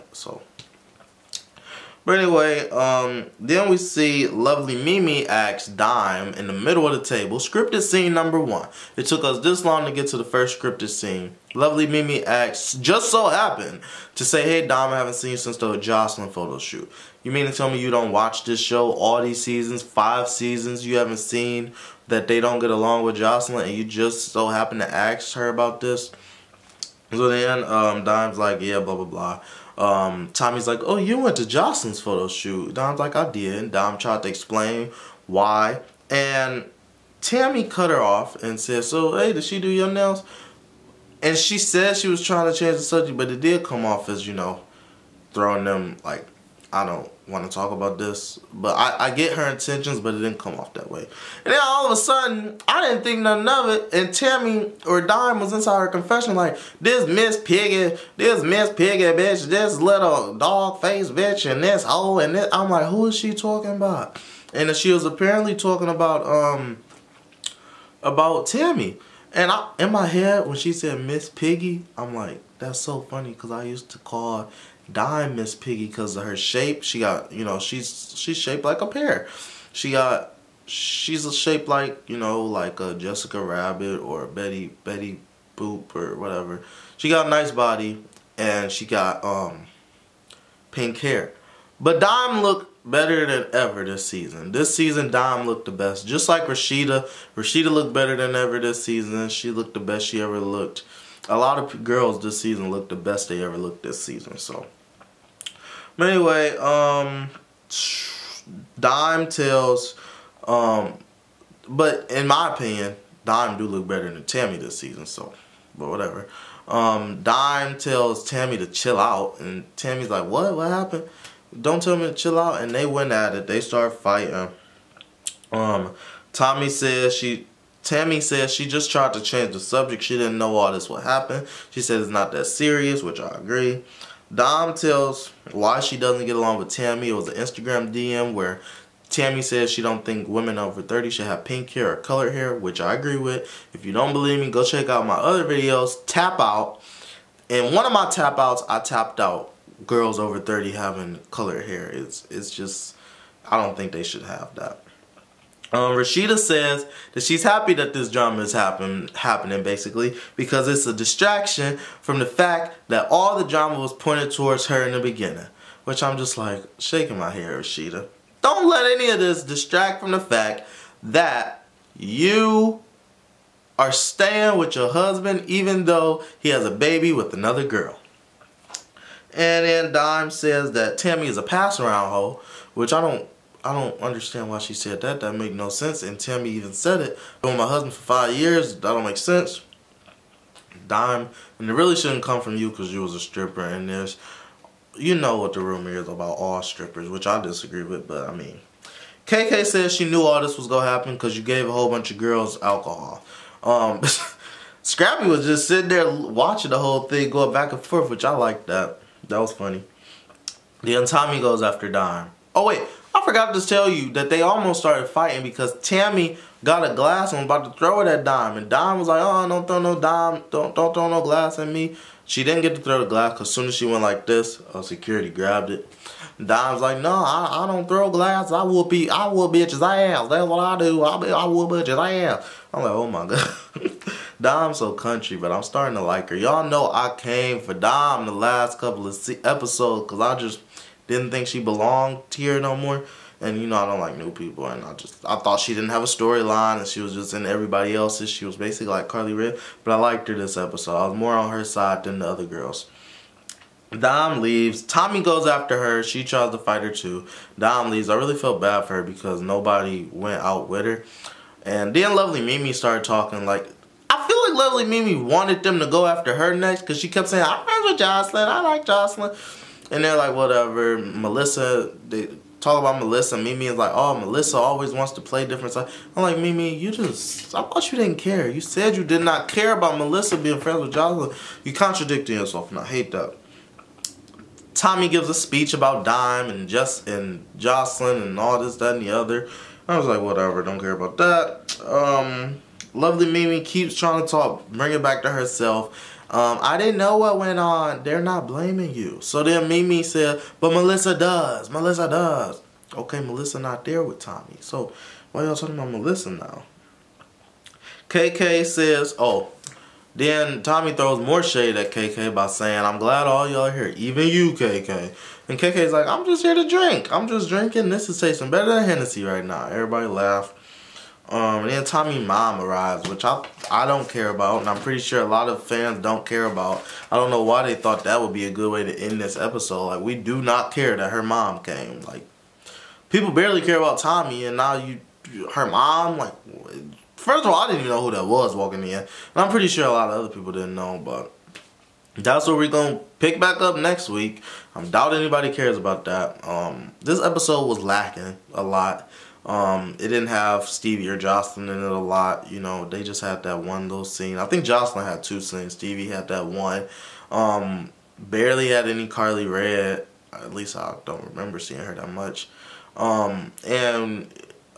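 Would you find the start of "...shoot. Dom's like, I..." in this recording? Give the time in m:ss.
0:32.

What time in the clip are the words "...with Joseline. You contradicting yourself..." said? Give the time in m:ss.
4:40.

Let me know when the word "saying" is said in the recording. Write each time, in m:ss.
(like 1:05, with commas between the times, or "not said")
4:27, 5:12.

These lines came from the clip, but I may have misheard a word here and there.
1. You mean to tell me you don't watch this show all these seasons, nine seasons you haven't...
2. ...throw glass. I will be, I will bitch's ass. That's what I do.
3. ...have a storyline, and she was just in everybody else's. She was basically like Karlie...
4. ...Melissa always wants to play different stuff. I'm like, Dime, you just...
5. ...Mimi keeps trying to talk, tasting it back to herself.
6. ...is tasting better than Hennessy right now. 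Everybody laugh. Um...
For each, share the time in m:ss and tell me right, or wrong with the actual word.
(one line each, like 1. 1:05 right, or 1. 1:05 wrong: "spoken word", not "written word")
1. 0:17 wrong: "five", not "nine"
2. 3:47 right
3. 4:05 right
4. 4:34 wrong: "Mimi", not "Dime"
5. 4:53 wrong: "bring", not "tasting"
6. 5:18 right.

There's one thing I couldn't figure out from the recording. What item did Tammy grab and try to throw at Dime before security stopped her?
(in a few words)
A glass.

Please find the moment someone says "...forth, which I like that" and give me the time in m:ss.
3:27.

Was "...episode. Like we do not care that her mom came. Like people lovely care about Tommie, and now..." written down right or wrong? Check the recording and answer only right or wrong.
wrong.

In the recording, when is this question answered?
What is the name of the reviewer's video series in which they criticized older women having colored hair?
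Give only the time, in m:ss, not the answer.
2:26.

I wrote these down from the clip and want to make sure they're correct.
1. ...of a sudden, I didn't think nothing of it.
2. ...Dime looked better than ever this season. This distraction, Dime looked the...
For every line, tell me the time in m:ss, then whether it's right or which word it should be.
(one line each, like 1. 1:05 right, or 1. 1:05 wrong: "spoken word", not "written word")
1. 0:51 right
2. 1:31 wrong: "season", not "distraction".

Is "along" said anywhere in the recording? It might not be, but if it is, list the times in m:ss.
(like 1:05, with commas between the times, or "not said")
0:22, 2:16.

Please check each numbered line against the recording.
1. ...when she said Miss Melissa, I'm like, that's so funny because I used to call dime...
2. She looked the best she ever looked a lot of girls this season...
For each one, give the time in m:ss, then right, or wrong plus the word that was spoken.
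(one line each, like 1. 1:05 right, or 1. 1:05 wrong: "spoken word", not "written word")
1. 1:10 wrong: "Piggy", not "Melissa"
2. 1:39 right.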